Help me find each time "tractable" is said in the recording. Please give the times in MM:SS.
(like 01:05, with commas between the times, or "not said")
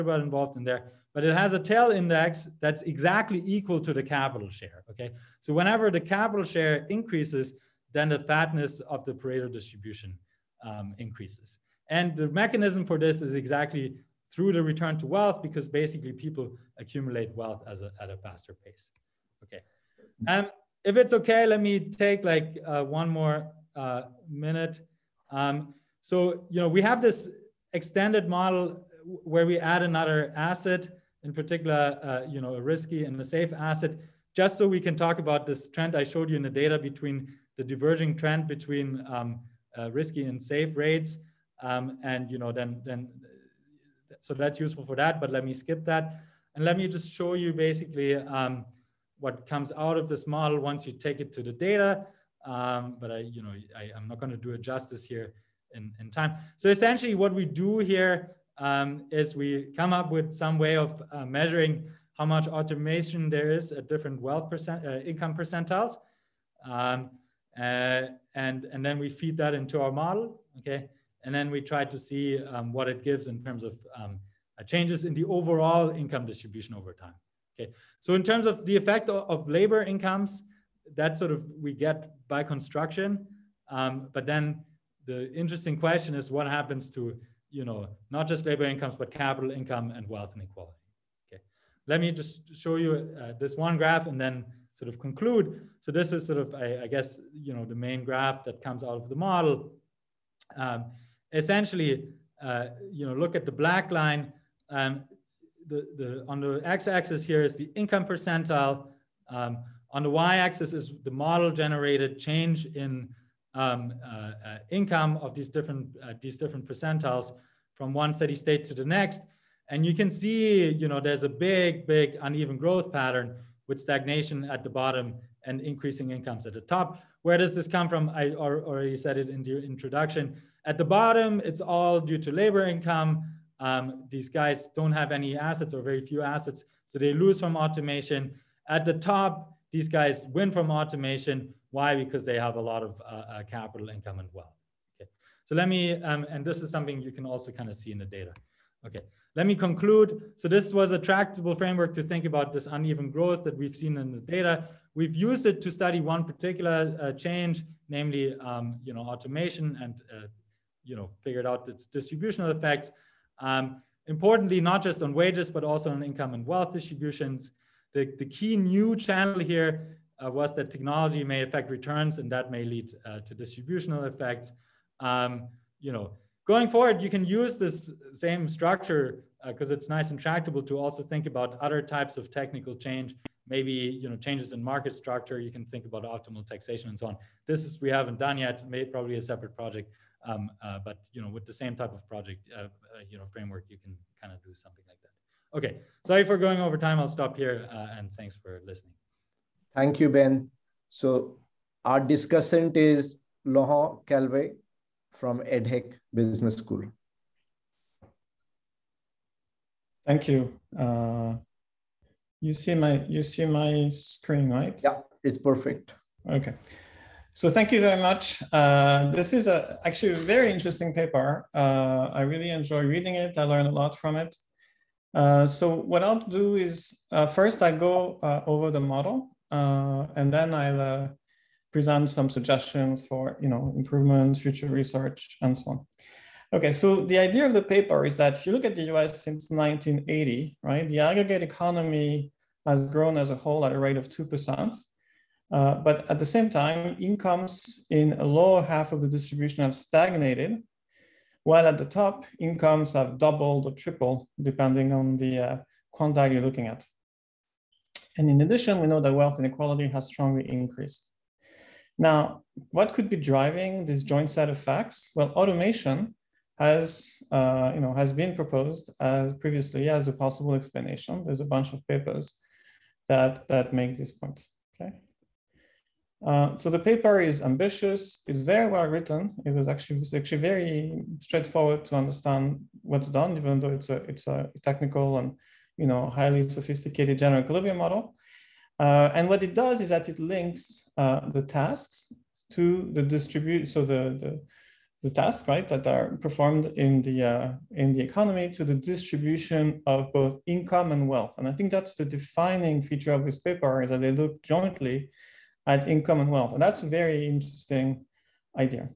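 02:30, 03:00.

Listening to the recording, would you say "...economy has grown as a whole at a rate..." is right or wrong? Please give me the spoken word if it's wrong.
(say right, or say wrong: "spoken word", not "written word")
right.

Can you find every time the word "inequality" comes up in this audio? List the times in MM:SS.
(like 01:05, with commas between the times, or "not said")
01:30, 04:19.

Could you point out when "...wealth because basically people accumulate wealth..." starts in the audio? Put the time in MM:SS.
00:15.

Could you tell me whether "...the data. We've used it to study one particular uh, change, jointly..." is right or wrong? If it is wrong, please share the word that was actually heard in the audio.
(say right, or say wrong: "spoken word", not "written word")
wrong: "namely", not "jointly".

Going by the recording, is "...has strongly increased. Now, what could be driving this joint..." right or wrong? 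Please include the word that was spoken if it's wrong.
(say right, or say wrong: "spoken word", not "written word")
right.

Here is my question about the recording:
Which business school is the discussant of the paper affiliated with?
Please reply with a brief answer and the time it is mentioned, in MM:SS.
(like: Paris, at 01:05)
EDHEC Business School, at 03:25.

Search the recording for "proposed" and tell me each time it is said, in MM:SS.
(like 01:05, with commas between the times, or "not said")
04:28.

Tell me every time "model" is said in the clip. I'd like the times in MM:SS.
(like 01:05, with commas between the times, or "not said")
00:28, 00:50, 01:09, 01:39, 01:51, 03:48, 04:47.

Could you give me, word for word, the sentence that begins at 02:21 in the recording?
Because they have a lot of uh, uh, capital income and wealth.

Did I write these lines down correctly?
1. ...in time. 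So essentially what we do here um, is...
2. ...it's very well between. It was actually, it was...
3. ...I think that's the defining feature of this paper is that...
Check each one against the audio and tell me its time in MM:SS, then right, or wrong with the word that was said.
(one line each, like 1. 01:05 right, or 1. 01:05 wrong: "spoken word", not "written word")
1. 00:55 right
2. 04:38 wrong: "written", not "between"
3. 05:01 right.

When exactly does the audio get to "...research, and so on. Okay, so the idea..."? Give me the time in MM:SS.
03:54.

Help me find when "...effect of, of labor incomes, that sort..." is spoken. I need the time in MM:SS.
01:18.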